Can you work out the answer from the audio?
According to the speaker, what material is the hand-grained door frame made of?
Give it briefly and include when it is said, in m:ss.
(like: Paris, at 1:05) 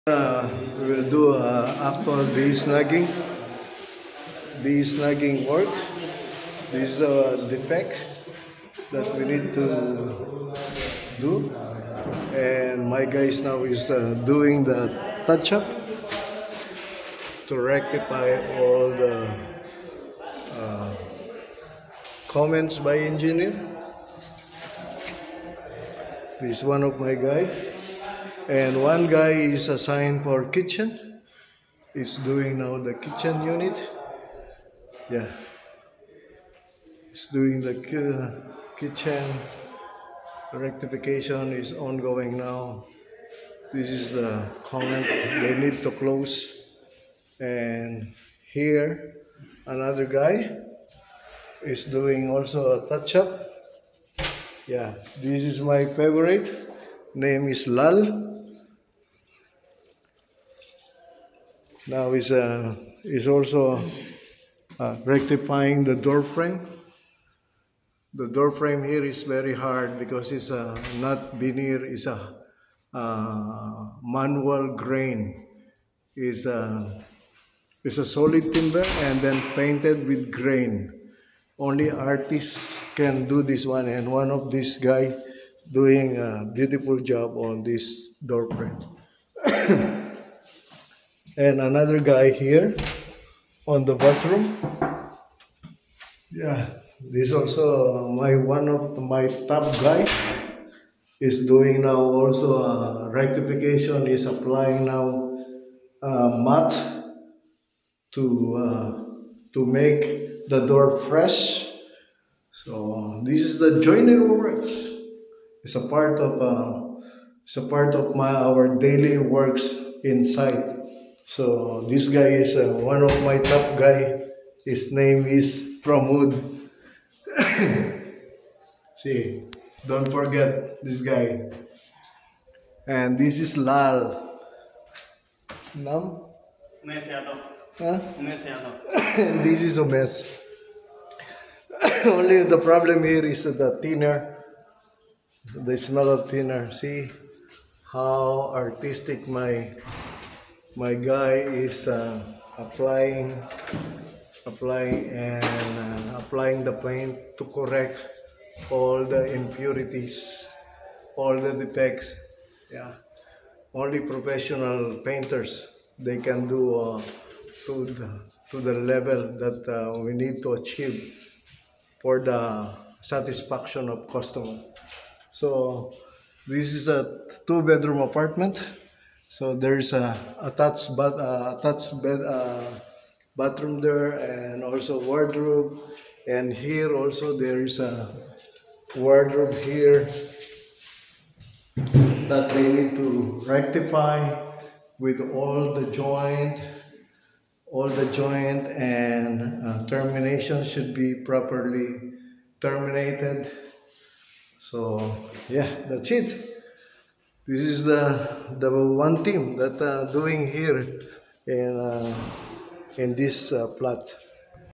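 Solid timber, at 1:18.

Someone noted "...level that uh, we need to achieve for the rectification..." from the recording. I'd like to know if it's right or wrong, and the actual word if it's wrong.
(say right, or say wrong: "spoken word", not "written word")
wrong: "satisfaction", not "rectification".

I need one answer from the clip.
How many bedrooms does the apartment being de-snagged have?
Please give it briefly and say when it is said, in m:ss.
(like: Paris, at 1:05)
2, at 2:57.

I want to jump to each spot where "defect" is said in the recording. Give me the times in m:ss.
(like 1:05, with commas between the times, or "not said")
0:07, 2:41.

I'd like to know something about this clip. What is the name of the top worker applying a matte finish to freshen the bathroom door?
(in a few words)
Pramud.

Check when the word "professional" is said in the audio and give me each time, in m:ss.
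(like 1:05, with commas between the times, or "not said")
2:44.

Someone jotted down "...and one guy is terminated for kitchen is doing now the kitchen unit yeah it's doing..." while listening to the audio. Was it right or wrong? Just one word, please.
wrong.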